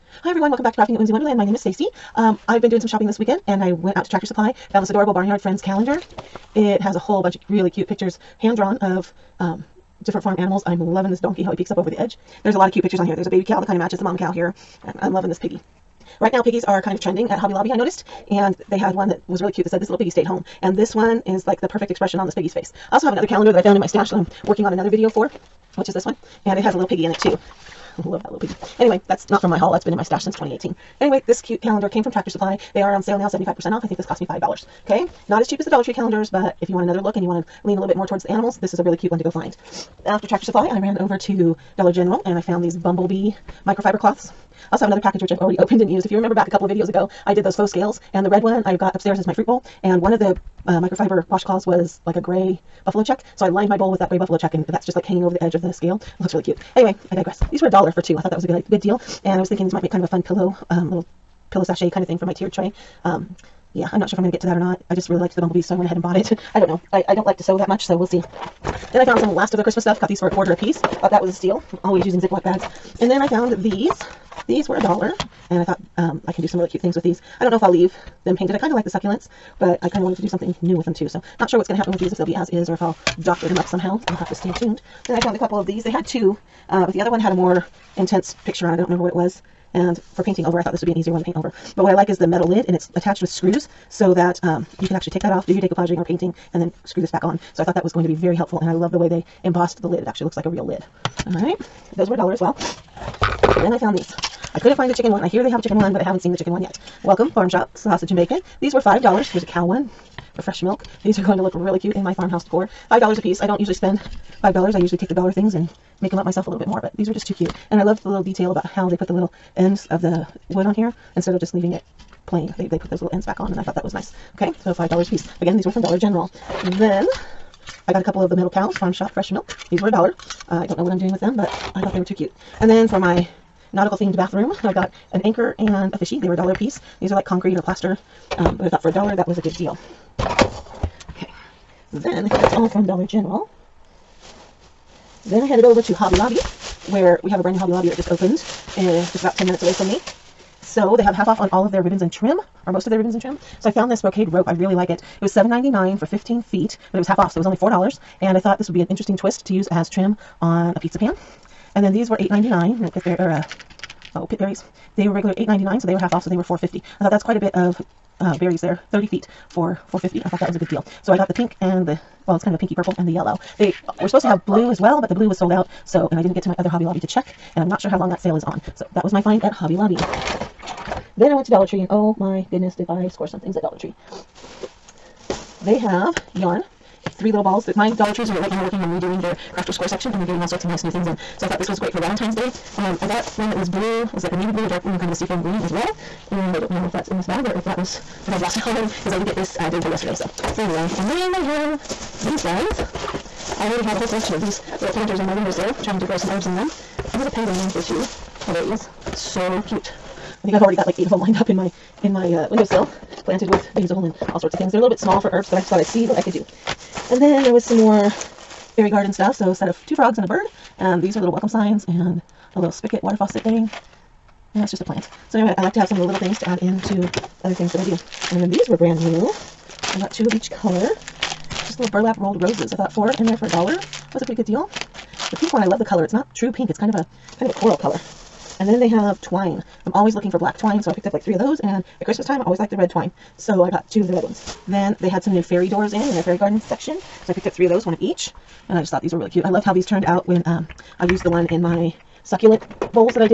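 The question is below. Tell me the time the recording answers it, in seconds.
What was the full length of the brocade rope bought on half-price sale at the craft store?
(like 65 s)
156 s.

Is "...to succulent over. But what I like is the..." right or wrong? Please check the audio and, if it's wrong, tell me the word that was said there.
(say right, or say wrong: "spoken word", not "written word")
wrong: "paint", not "succulent".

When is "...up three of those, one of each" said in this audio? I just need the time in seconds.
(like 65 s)
247 s.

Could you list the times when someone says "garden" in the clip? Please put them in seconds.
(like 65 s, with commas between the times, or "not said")
218 s, 246 s.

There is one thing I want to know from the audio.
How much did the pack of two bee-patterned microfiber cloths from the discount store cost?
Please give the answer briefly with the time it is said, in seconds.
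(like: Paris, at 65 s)
a dollar for two, at 57 s.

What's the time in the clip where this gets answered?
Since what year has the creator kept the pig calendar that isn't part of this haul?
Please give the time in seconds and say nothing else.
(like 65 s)
30 s.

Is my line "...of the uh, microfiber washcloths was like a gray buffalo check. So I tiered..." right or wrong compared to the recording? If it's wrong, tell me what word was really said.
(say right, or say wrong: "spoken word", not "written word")
wrong: "lined", not "tiered".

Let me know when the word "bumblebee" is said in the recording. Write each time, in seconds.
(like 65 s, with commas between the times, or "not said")
42 s, 65 s.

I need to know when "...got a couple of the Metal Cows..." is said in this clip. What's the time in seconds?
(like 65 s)
127 s.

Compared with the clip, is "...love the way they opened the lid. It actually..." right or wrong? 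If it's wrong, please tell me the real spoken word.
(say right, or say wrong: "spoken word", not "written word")
wrong: "embossed", not "opened".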